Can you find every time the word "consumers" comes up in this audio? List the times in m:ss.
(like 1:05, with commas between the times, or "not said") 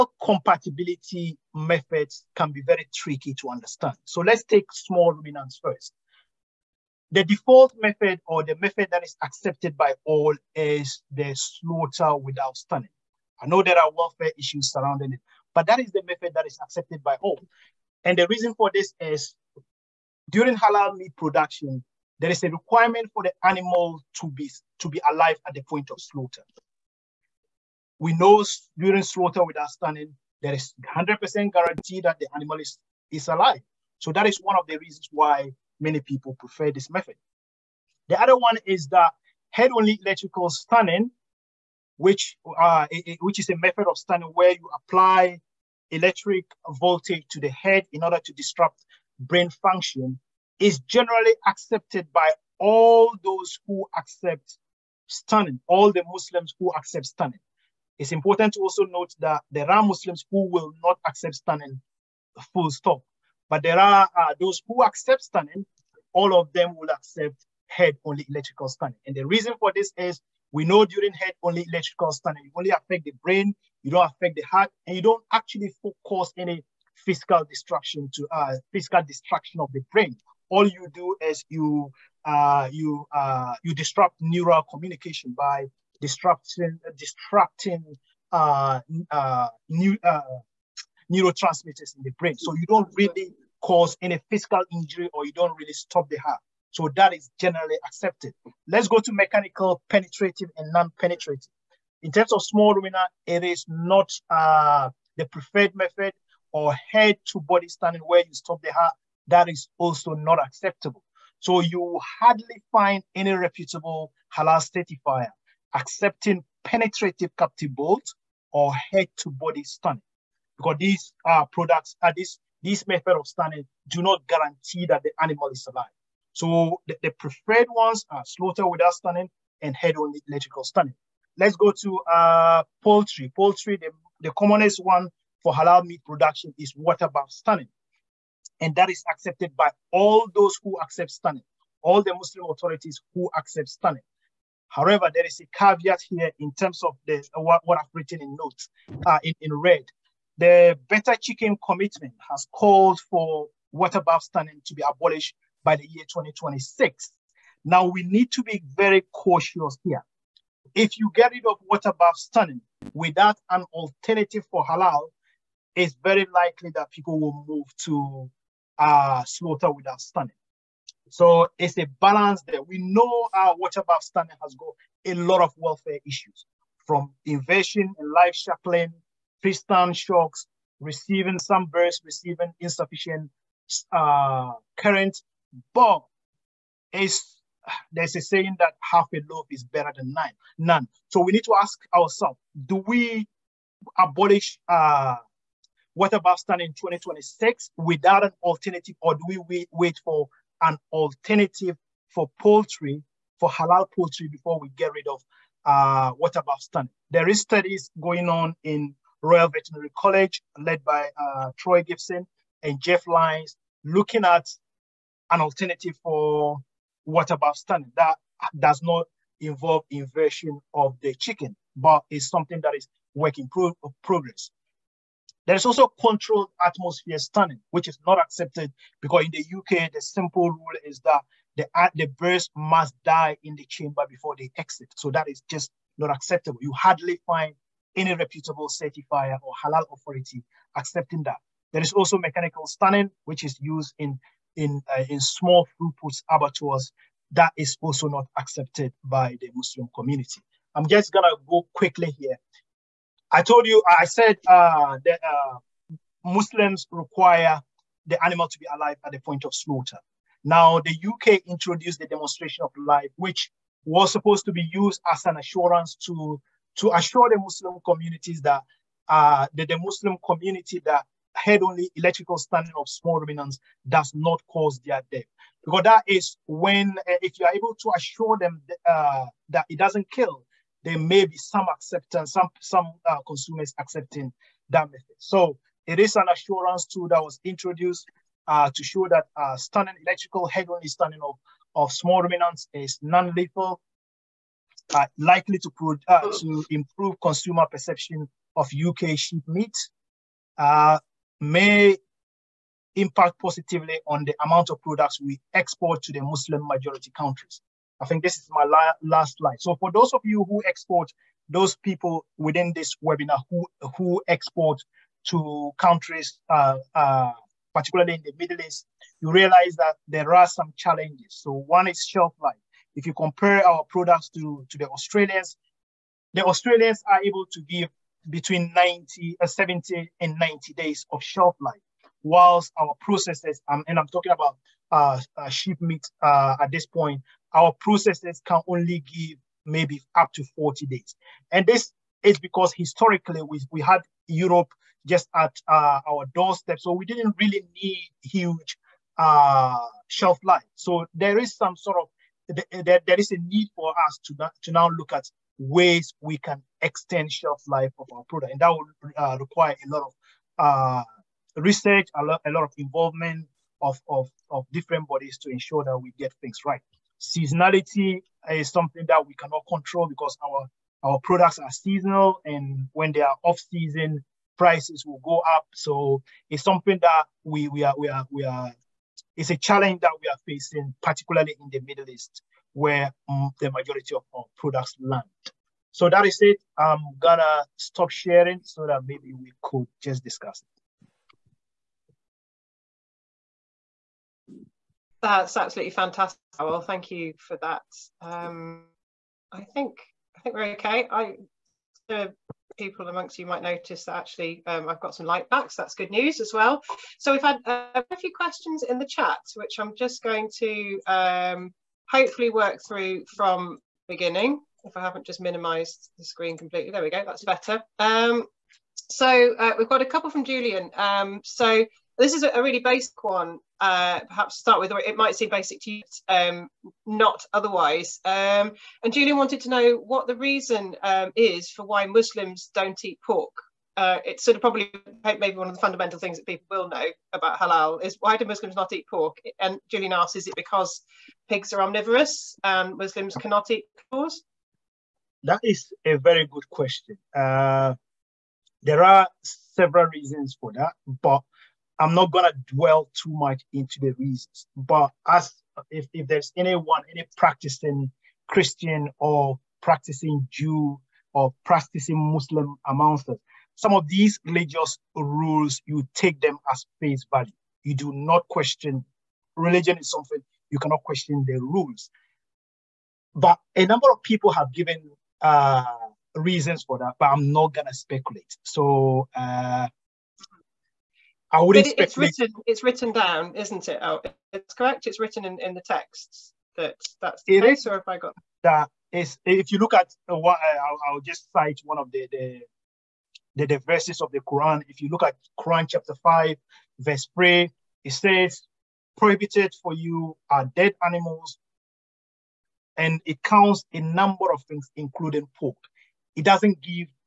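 4:43, 4:57.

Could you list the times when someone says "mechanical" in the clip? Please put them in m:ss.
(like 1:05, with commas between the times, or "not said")
1:39, 4:02.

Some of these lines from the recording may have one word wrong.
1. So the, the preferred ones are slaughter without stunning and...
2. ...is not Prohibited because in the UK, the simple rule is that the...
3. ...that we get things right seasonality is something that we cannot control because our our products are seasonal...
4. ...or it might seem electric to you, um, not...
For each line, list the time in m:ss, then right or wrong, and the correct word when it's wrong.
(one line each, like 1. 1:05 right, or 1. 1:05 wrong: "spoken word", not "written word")
1. 2:06 right
2. 3:47 wrong: "accepted", not "Prohibited"
3. 6:05 right
4. 7:04 wrong: "basic", not "electric".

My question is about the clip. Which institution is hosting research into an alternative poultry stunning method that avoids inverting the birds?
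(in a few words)
Royal Veterinary College.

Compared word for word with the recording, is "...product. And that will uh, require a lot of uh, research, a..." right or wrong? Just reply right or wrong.
right.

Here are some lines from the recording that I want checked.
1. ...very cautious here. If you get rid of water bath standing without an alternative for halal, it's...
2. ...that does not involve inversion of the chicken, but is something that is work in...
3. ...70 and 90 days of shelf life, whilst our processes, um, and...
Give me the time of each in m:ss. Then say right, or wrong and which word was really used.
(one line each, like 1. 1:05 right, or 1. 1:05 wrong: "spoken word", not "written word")
1. 2:38 right
2. 3:37 right
3. 5:29 right.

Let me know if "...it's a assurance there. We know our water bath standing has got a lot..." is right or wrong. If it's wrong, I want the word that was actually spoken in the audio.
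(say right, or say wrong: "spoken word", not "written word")
wrong: "balance", not "assurance".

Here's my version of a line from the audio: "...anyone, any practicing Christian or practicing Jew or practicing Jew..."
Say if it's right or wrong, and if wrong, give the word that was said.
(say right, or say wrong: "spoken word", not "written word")
wrong: "Muslim", not "Jew".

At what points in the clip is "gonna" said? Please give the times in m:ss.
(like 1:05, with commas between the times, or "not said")
4:11, 6:27, 7:32, 7:57.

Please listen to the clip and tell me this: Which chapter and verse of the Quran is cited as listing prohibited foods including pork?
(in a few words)
Chapter 5, verse 3.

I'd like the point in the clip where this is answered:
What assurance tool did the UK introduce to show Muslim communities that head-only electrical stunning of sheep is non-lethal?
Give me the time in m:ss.
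4:22.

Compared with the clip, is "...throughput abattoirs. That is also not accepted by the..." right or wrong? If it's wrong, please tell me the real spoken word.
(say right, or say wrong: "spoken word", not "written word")
right.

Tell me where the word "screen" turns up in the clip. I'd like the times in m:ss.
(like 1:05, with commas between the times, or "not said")
6:56.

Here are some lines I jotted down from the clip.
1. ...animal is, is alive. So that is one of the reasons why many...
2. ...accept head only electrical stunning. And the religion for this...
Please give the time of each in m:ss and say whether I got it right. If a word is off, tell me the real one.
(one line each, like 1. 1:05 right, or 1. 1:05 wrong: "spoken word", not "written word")
1. 0:32 right
2. 1:06 wrong: "reason", not "religion".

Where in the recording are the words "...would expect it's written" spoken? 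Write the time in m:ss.
8:01.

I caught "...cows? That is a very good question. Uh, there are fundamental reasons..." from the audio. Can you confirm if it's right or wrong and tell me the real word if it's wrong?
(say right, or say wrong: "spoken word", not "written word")
wrong: "several", not "fundamental".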